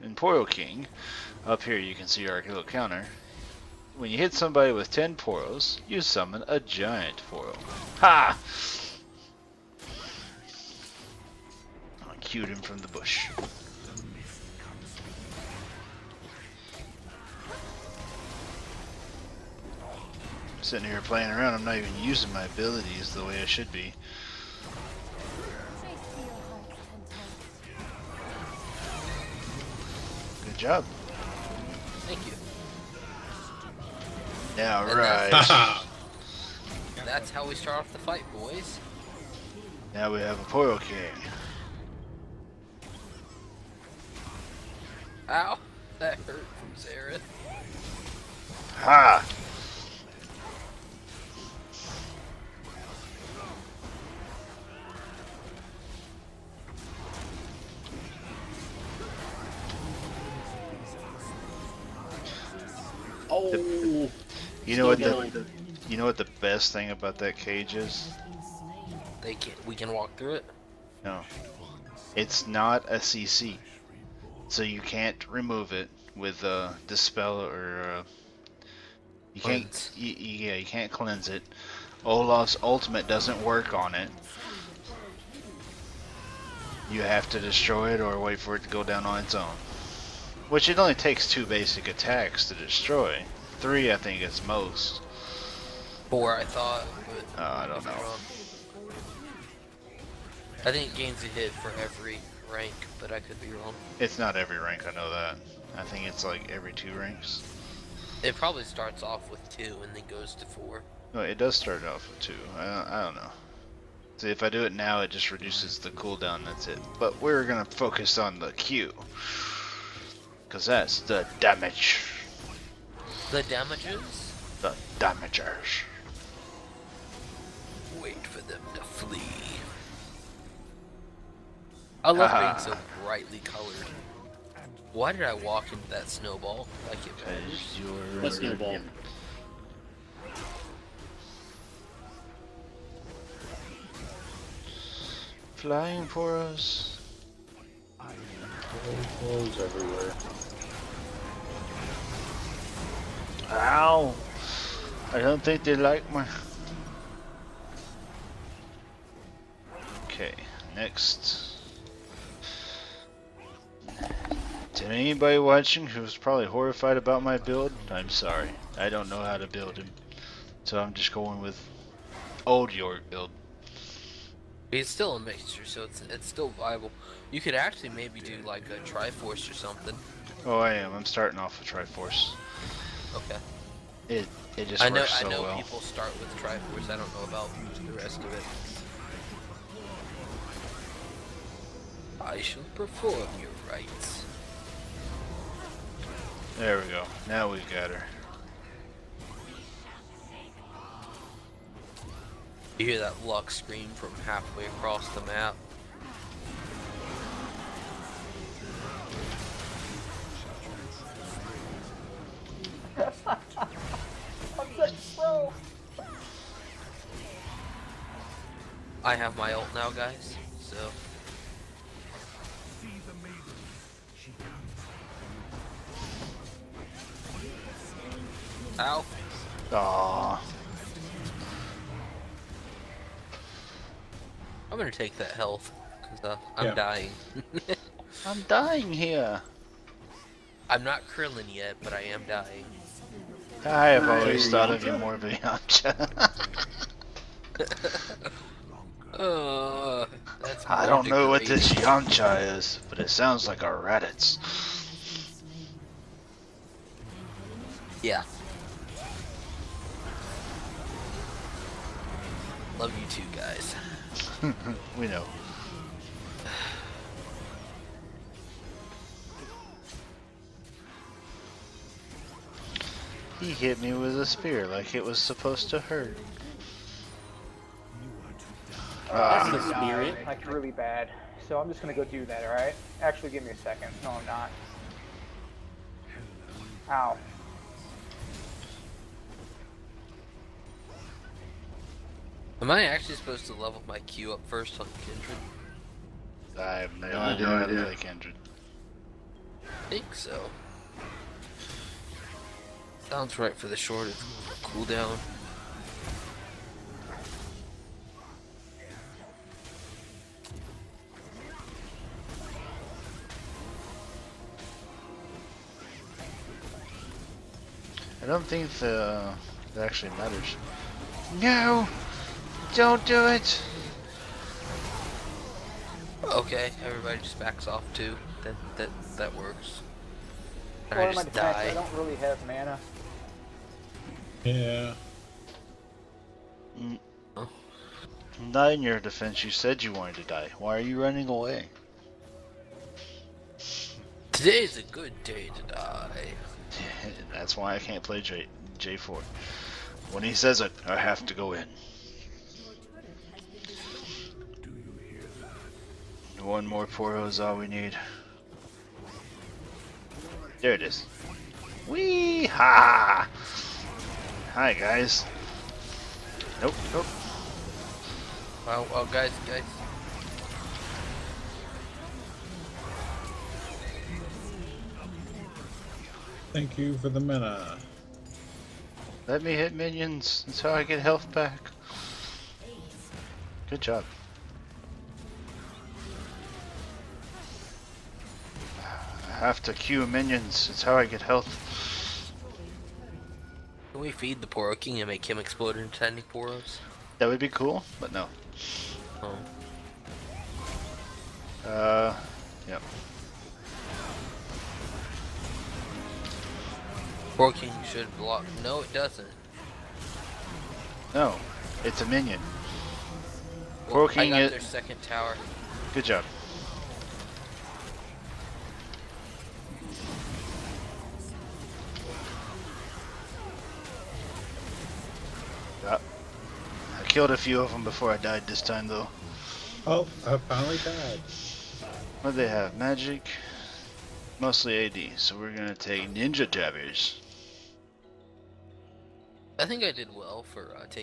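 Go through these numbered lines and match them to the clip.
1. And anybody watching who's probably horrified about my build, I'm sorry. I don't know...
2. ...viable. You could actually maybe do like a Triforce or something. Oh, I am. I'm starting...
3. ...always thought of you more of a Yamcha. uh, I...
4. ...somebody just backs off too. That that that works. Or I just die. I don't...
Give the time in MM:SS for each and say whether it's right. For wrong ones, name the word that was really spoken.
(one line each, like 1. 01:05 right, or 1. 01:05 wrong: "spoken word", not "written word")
1. 02:44 right
2. 02:56 right
3. 04:04 right
4. 05:26 wrong: "everybody", not "somebody".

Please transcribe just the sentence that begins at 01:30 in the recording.
Which it only takes two basic attacks to destroy.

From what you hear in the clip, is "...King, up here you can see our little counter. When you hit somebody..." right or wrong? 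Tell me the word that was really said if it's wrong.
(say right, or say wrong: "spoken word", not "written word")
right.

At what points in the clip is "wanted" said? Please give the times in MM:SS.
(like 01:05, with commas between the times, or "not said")
05:39.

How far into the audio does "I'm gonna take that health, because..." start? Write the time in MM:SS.
03:54.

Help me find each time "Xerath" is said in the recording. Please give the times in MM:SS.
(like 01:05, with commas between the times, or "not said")
00:46.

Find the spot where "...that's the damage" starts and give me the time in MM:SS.
02:00.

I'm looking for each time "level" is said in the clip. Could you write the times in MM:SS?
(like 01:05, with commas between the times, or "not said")
04:53.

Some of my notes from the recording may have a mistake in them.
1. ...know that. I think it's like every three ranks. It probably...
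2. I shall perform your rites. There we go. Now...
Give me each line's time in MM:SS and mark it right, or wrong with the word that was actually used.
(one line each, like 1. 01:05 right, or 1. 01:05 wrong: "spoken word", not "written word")
1. 01:44 wrong: "two", not "three"
2. 03:12 right.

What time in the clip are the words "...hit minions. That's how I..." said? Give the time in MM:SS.
06:19.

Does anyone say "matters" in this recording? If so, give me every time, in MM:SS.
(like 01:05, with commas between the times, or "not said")
02:17, 05:20.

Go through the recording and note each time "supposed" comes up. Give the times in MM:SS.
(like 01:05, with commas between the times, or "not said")
04:35, 04:53.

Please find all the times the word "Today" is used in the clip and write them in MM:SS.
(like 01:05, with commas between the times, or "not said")
05:44.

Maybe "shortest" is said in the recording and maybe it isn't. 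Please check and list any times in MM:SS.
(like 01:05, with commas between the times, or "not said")
05:03.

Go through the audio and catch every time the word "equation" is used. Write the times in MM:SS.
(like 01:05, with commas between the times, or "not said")
not said.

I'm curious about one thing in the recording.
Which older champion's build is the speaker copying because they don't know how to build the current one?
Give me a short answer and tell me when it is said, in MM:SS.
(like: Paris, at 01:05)
Yorick, at 02:52.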